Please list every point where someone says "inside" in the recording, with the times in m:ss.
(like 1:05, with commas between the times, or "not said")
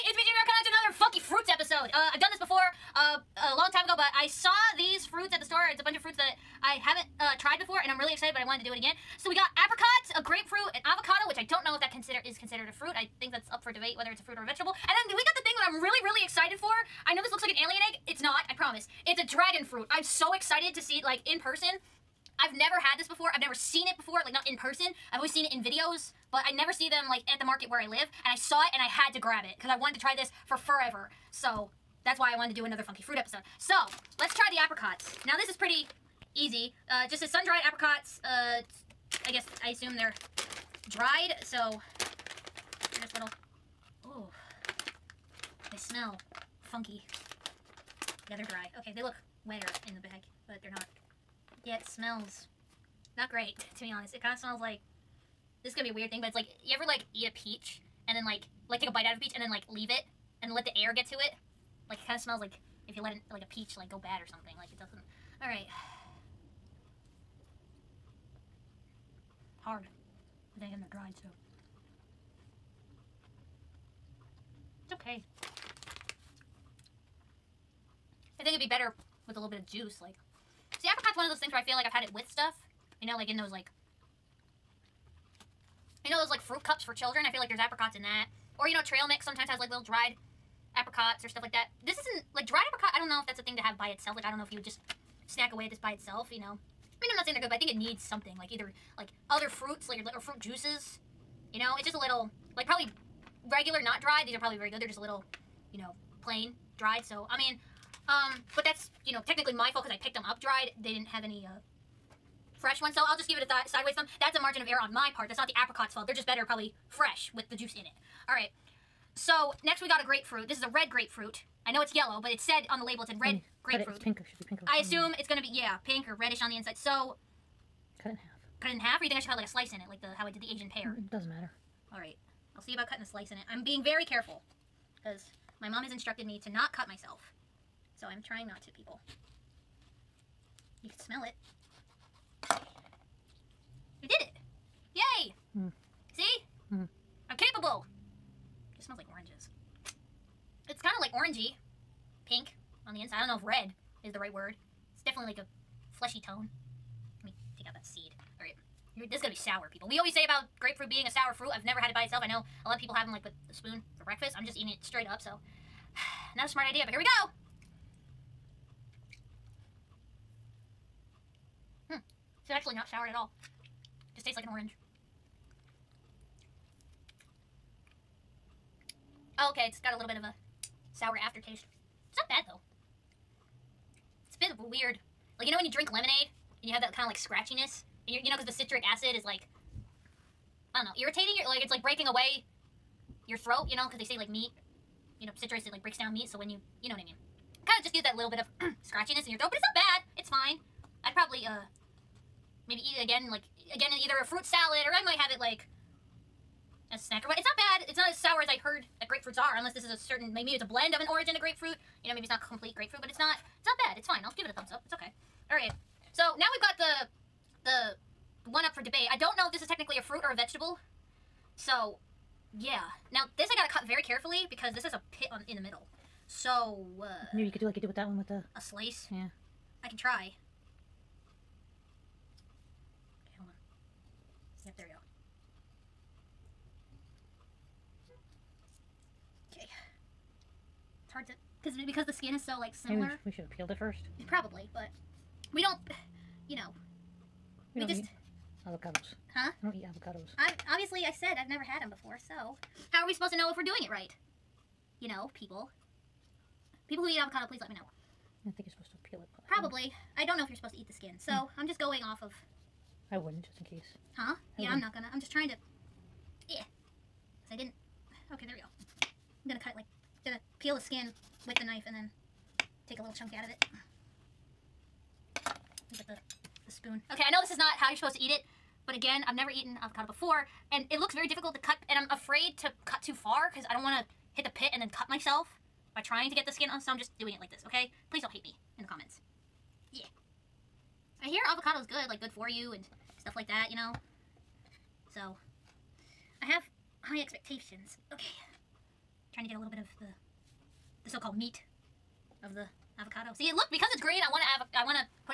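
2:06, 2:33.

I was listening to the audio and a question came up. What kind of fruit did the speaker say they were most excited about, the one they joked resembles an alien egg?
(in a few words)
Dragon fruit.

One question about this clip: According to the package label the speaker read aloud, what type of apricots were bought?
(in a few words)
Sun-dried.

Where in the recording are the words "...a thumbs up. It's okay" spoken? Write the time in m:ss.
3:34.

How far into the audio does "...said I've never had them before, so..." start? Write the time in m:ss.
4:11.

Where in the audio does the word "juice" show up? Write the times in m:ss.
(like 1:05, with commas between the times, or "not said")
1:19, 1:40, 1:57.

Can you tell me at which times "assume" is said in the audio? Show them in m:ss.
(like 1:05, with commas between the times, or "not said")
0:39, 2:04.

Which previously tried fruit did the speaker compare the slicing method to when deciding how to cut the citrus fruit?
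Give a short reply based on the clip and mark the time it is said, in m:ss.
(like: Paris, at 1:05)
Asian pear, at 2:10.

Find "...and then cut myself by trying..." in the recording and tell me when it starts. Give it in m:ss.
4:44.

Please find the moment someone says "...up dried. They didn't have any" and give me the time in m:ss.
1:50.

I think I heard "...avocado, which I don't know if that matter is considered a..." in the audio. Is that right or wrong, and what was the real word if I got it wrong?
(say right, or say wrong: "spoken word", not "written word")
wrong: "consider", not "matter".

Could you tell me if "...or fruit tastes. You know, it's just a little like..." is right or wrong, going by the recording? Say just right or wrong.
wrong.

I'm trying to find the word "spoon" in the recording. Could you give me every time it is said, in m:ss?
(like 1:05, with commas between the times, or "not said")
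2:43, 4:36.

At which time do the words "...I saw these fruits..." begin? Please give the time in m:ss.
0:04.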